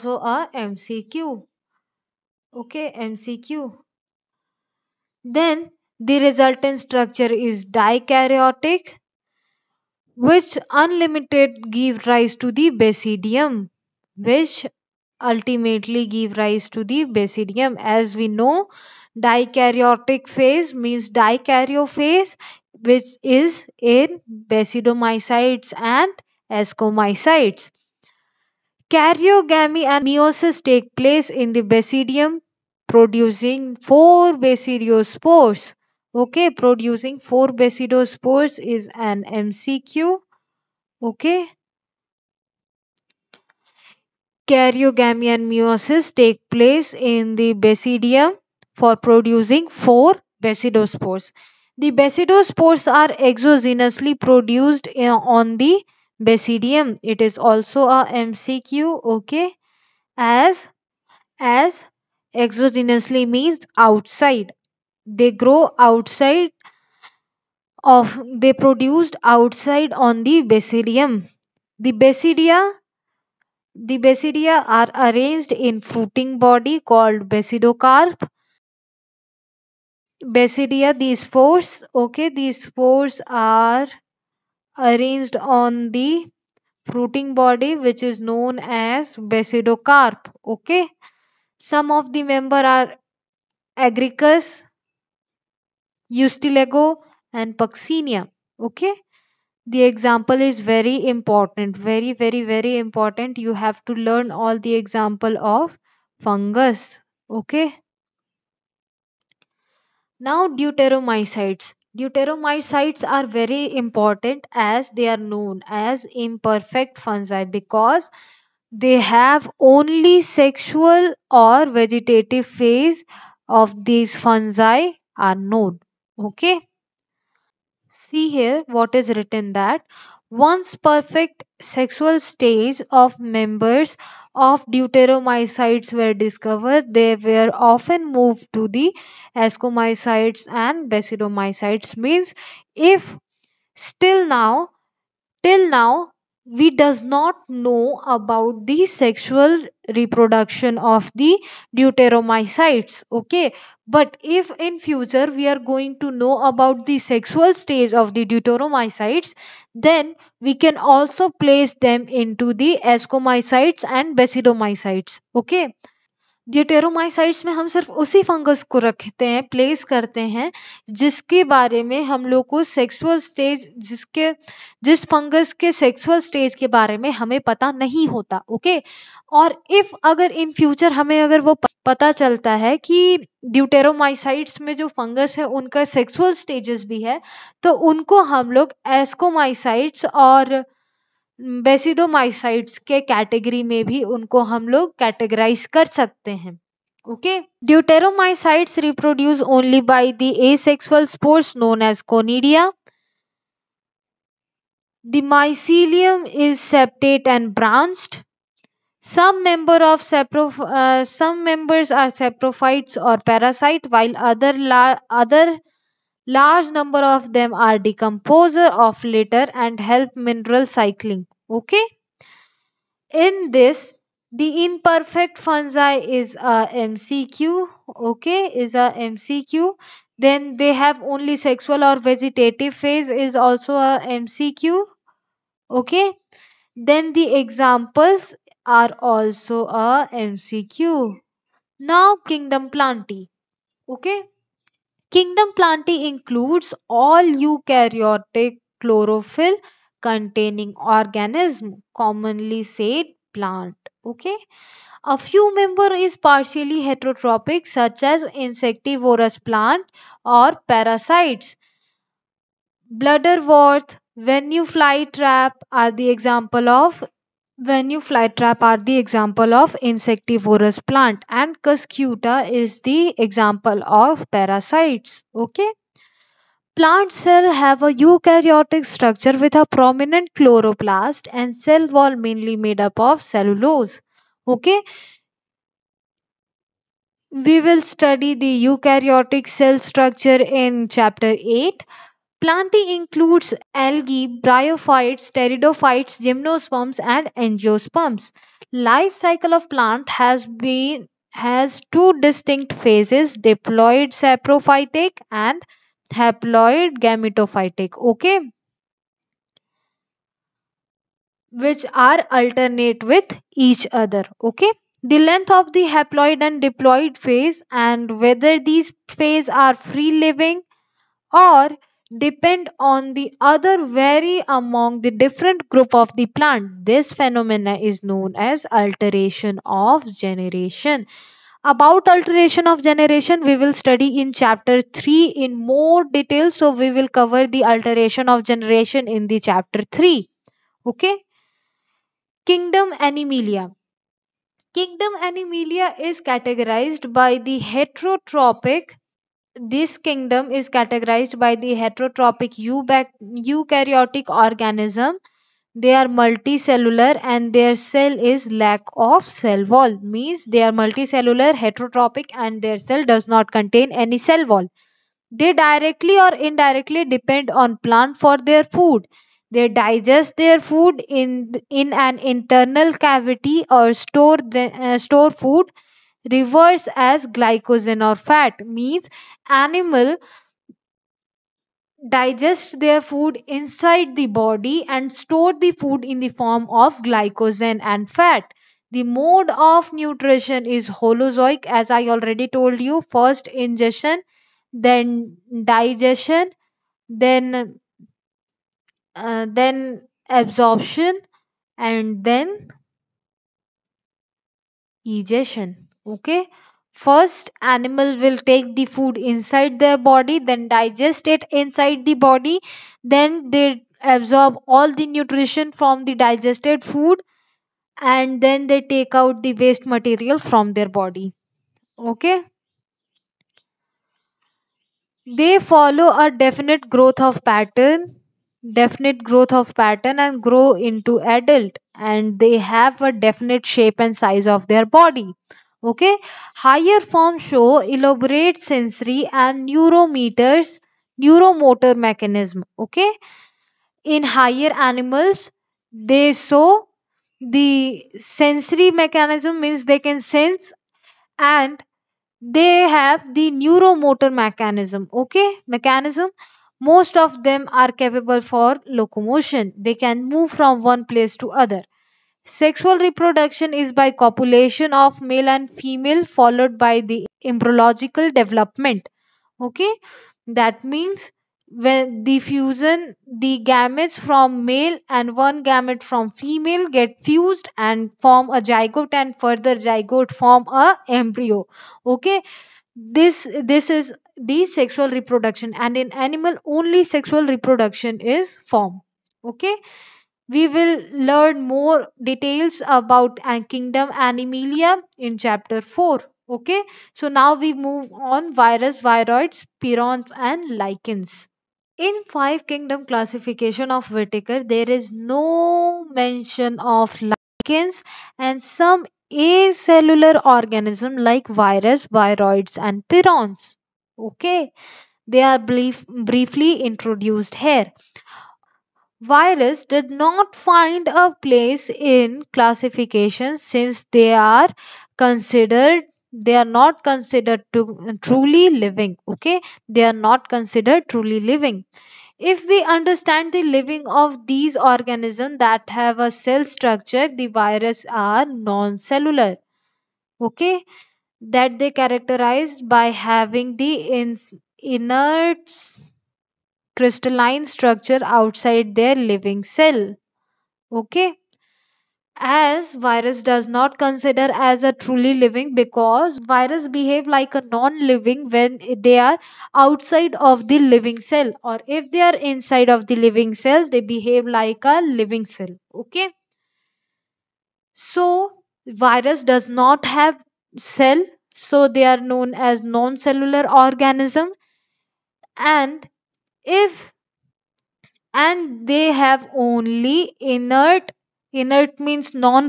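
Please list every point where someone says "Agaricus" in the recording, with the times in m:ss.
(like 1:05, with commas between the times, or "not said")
1:33.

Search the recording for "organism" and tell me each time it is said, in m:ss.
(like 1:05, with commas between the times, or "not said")
4:10, 5:54, 8:30, 8:54, 9:33.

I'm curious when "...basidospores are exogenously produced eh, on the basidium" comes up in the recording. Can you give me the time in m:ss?
0:51.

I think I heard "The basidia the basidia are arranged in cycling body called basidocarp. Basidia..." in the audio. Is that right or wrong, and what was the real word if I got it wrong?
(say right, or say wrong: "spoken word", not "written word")
wrong: "fruiting", not "cycling".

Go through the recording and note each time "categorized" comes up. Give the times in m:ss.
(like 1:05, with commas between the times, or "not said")
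5:46, 5:50.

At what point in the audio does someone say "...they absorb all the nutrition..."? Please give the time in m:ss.
6:53.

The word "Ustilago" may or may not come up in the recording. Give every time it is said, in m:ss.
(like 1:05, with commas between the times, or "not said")
1:36.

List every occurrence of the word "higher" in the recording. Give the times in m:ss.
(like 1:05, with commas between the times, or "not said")
7:16, 7:24.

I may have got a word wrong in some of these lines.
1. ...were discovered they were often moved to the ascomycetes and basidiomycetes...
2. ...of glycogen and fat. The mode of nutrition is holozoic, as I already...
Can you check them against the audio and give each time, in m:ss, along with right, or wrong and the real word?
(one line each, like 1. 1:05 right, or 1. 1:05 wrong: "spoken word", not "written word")
1. 2:16 right
2. 6:26 right.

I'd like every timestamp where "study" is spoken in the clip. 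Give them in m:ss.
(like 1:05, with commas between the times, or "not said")
4:47, 5:33.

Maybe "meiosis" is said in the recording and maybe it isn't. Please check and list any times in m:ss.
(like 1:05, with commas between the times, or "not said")
0:30, 0:45.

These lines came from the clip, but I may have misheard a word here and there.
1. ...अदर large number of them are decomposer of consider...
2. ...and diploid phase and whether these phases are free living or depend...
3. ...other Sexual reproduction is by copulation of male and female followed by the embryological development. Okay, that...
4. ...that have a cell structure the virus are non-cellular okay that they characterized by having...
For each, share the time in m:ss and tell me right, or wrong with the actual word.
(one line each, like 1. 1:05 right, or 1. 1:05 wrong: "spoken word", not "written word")
1. 3:35 wrong: "litter", not "consider"
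2. 5:16 right
3. 7:41 right
4. 8:55 right.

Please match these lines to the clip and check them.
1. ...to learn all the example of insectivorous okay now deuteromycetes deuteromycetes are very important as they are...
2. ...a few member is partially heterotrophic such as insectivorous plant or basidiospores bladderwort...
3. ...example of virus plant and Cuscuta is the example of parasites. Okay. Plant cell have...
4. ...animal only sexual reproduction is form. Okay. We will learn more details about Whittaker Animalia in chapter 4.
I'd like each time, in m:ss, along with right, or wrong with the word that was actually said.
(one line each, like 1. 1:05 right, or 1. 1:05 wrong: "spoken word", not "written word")
1. 1:43 wrong: "fungus", not "insectivorous"
2. 4:15 wrong: "parasites", not "basidiospores"
3. 4:28 wrong: "insectivorous", not "virus"
4. 8:06 wrong: "Kingdom", not "Whittaker".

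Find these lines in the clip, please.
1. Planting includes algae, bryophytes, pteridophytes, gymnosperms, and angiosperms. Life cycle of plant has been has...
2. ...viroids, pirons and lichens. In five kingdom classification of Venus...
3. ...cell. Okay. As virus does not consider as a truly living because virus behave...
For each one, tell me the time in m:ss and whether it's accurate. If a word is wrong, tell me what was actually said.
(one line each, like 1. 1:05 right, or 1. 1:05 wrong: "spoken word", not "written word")
1. 4:52 right
2. 8:19 wrong: "Whittaker", not "Venus"
3. 9:09 right.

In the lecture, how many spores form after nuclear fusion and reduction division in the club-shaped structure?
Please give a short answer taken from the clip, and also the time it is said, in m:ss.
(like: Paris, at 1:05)
4, at 0:32.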